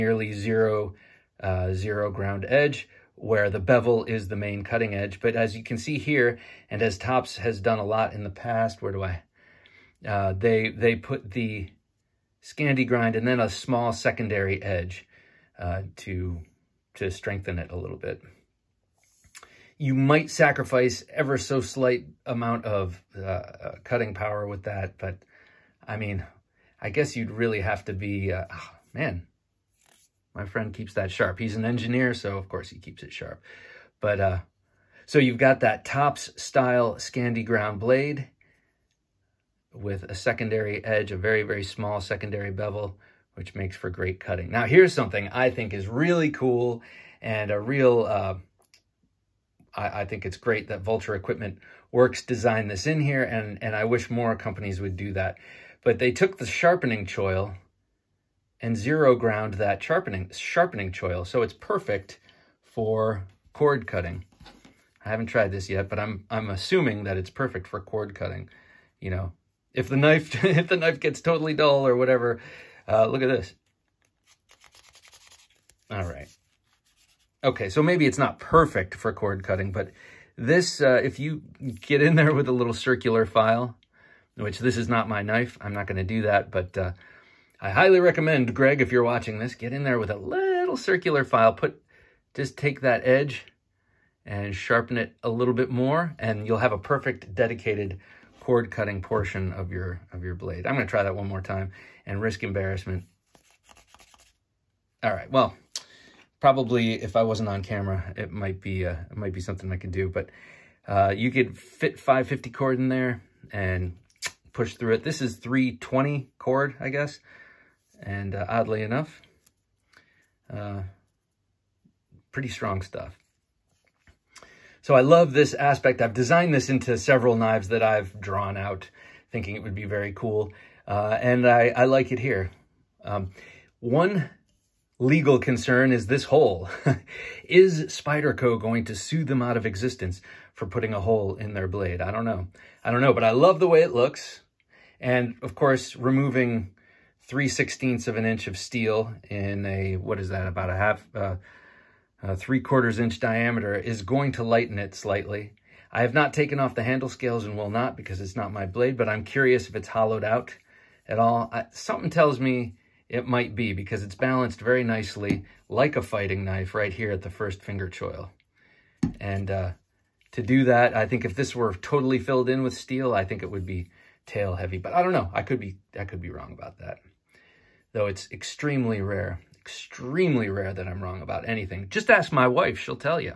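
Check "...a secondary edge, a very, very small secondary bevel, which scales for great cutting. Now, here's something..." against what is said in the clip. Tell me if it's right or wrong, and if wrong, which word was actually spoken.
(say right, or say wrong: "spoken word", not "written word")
wrong: "makes", not "scales".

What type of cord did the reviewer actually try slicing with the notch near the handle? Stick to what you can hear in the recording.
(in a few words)
320 cord.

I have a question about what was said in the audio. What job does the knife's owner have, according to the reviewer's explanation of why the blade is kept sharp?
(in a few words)
Engineer.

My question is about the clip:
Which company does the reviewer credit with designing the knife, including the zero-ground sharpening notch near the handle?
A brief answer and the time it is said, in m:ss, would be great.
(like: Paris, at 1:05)
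Vulture Equipment Works, at 0:50.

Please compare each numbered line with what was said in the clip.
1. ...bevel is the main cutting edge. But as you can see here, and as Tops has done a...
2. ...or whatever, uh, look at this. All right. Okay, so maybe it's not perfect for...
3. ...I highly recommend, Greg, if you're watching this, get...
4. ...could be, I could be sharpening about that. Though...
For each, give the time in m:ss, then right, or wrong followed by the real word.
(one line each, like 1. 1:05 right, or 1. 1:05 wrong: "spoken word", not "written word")
1. 0:03 right
2. 1:11 right
3. 1:27 right
4. 2:55 wrong: "wrong", not "sharpening".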